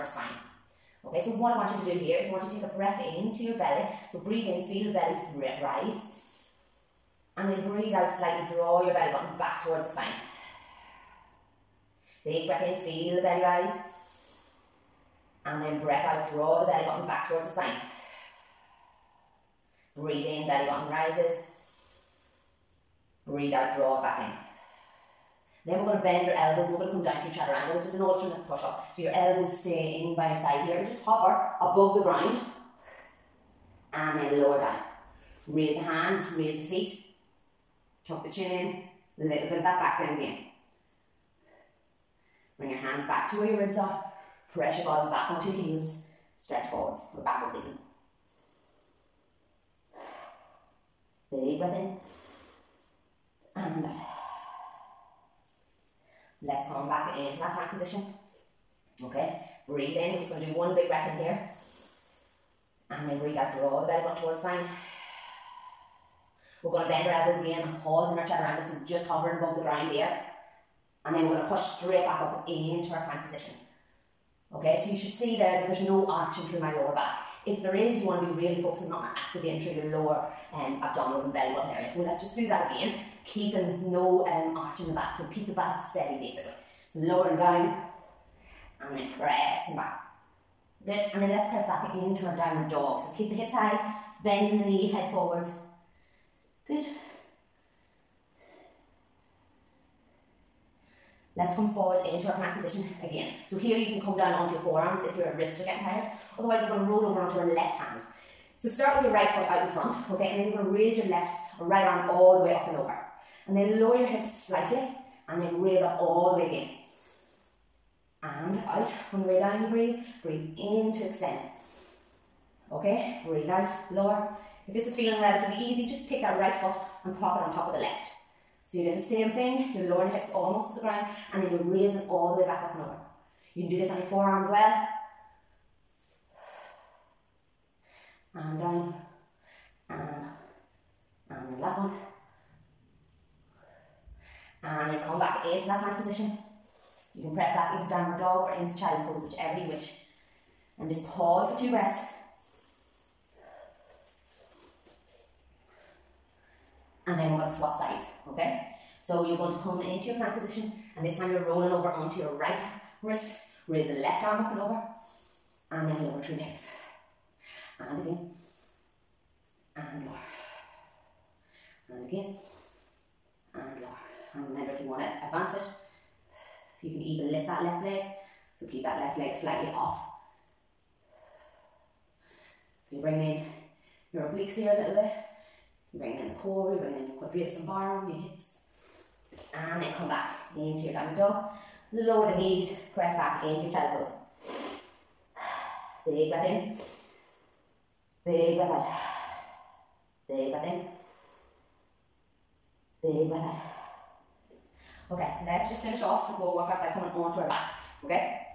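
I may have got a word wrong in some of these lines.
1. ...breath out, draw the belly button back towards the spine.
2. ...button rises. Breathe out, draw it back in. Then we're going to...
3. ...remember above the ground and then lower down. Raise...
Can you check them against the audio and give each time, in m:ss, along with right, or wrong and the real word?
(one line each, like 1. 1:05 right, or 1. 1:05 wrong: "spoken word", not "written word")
1. 0:15 right
2. 0:20 right
3. 0:31 wrong: "hover", not "remember".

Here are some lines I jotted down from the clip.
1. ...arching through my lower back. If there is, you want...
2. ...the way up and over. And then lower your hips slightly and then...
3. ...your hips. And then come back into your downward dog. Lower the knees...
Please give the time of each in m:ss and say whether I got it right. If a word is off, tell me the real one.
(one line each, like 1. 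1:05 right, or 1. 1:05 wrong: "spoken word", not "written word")
1. 1:16 right
2. 1:52 right
3. 3:08 right.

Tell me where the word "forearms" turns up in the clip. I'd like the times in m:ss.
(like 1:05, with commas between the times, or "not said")
1:44, 2:14.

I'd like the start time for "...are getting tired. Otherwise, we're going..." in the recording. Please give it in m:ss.
1:45.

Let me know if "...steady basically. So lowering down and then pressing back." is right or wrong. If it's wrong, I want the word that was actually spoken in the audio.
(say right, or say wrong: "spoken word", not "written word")
right.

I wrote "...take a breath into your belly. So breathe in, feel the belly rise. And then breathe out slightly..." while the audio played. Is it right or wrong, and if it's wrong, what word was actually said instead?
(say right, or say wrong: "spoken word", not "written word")
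right.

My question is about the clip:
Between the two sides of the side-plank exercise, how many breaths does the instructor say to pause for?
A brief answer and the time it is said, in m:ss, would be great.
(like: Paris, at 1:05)
2, at 2:31.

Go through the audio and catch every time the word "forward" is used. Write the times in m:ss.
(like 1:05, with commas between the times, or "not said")
0:46, 1:35, 1:41.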